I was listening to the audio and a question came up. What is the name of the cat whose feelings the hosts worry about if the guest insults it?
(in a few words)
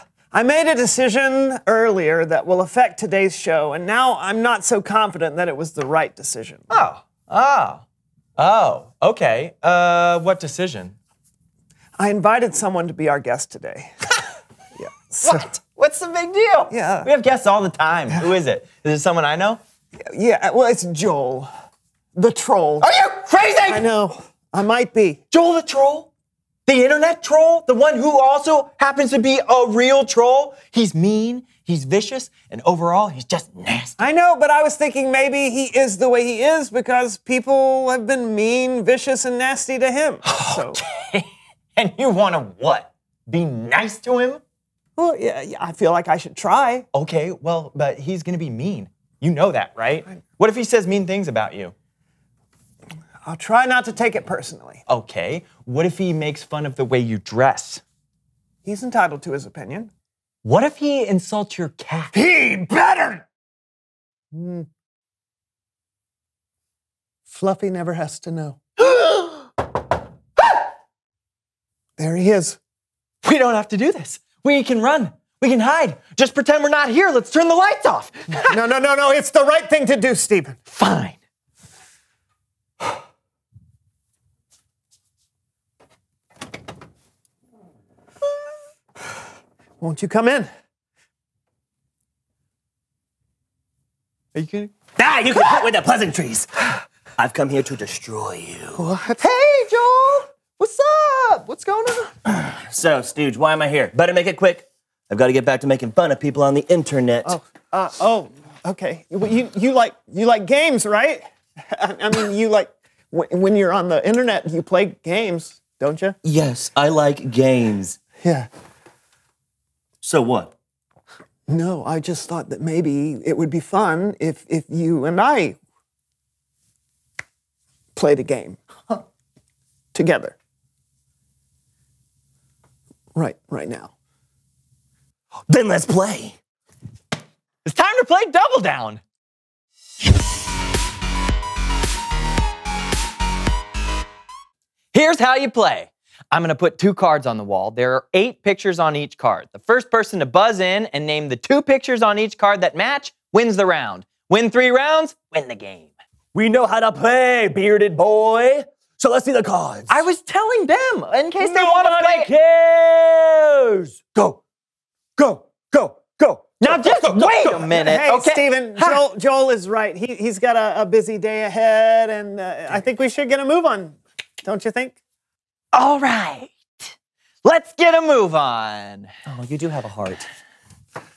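Fluffy.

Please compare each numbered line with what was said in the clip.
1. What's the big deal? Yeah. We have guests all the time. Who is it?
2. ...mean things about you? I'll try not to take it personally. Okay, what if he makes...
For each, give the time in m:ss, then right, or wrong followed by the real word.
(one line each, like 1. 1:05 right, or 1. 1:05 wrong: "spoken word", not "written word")
1. 0:15 right
2. 0:50 right.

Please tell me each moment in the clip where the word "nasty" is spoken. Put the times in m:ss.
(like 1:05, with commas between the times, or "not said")
0:33, 0:39.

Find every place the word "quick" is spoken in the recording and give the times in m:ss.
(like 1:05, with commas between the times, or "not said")
1:44.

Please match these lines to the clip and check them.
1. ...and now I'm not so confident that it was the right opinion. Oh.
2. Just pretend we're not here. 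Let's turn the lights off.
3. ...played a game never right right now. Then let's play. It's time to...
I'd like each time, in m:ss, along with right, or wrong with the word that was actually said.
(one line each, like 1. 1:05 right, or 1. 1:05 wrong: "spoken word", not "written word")
1. 0:03 wrong: "decision", not "opinion"
2. 1:16 right
3. 2:07 wrong: "together", not "never".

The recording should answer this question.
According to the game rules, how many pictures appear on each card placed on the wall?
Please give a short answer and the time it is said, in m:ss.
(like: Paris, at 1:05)
8, at 2:28.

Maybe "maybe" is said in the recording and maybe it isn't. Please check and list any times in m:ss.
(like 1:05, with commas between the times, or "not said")
0:35, 2:02.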